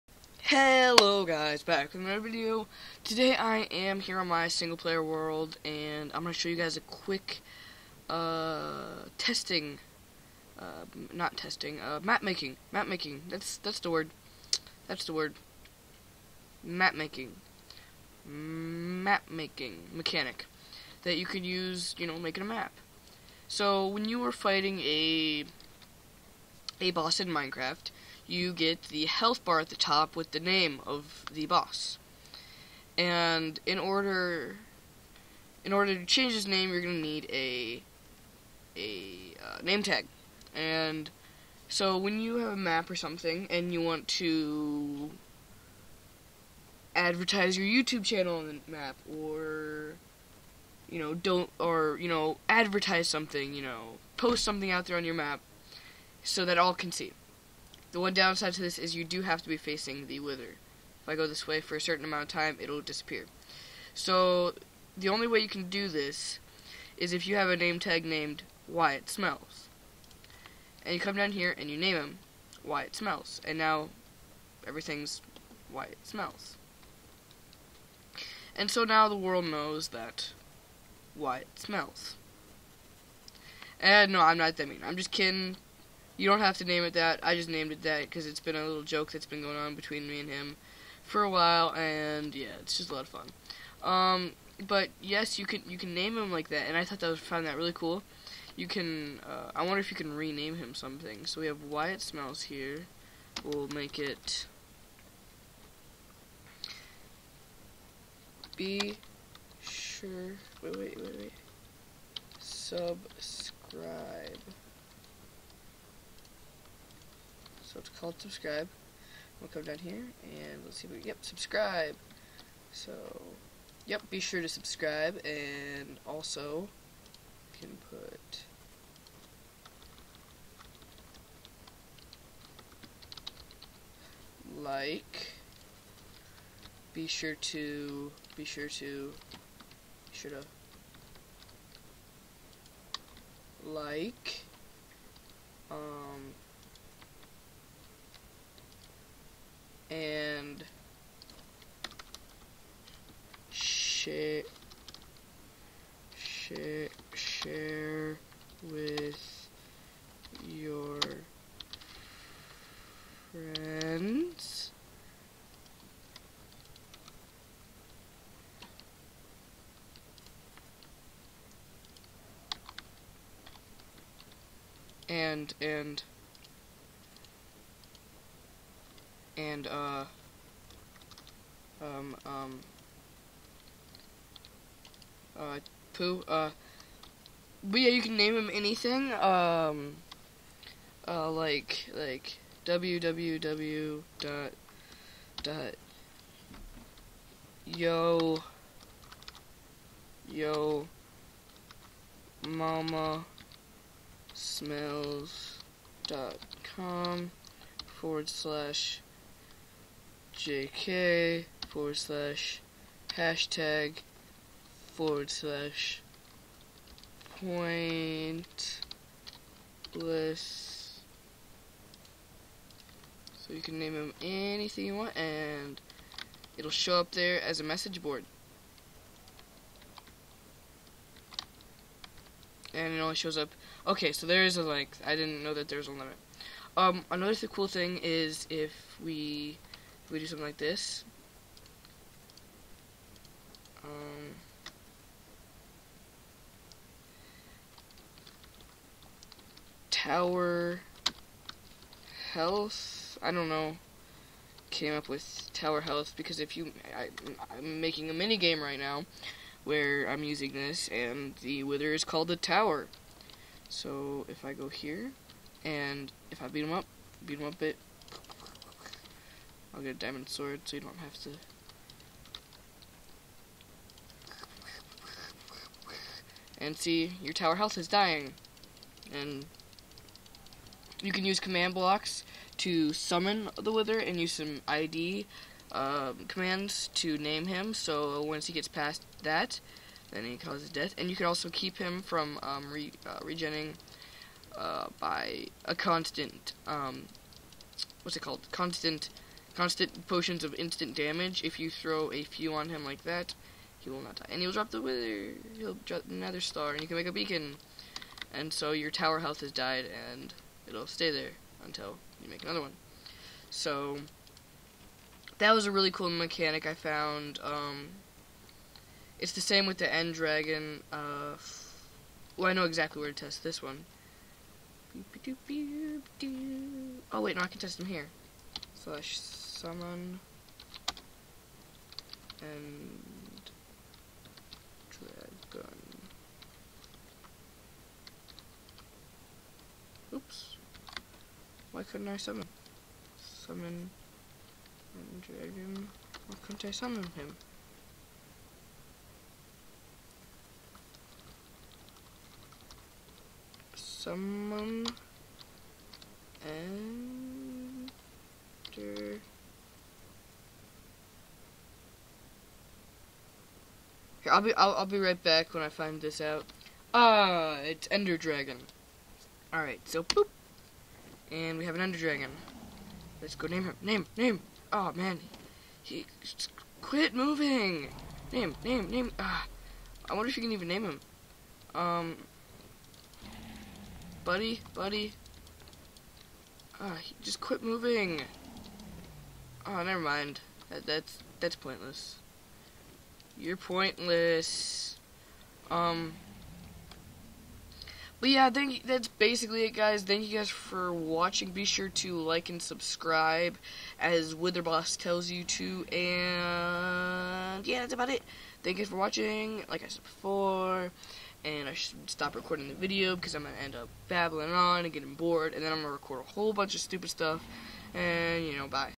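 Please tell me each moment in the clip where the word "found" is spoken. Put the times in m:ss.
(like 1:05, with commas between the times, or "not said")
1:37, 5:16.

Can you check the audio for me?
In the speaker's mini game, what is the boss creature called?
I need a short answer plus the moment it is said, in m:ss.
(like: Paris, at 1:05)
The tower, at 4:22.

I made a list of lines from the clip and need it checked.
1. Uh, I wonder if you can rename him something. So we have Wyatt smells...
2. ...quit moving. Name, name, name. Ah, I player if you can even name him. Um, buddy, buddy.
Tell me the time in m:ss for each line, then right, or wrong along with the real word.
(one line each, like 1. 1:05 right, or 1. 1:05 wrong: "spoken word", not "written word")
1. 1:39 right
2. 6:16 wrong: "wonder", not "player".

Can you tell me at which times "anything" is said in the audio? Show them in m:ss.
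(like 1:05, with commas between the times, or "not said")
3:08, 3:44.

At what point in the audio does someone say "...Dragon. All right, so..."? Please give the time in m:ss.
6:08.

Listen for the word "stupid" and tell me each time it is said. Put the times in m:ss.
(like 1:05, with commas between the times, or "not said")
6:56.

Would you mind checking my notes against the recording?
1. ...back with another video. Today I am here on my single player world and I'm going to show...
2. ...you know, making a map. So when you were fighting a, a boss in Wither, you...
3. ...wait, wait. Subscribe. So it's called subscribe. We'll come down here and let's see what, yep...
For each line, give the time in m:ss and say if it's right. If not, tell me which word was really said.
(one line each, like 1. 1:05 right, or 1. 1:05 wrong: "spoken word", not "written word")
1. 0:01 right
2. 0:21 wrong: "Minecraft", not "Wither"
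3. 1:51 right.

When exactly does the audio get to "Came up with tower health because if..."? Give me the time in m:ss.
4:14.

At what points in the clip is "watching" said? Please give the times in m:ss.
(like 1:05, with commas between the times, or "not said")
6:40, 6:48.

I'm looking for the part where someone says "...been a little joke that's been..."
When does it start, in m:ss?
1:28.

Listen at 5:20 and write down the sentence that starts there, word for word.
Uh, well, I know exactly where to test this one.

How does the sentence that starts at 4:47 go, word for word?
So once he gets past that, then he causes death.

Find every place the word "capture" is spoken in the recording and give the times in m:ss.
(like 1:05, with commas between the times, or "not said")
not said.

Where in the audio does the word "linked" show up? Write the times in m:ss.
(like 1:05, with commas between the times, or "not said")
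not said.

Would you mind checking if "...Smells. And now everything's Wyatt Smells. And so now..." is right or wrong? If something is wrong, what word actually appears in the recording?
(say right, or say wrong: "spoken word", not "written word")
right.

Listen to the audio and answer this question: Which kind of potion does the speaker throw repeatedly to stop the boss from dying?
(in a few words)
Instant damage.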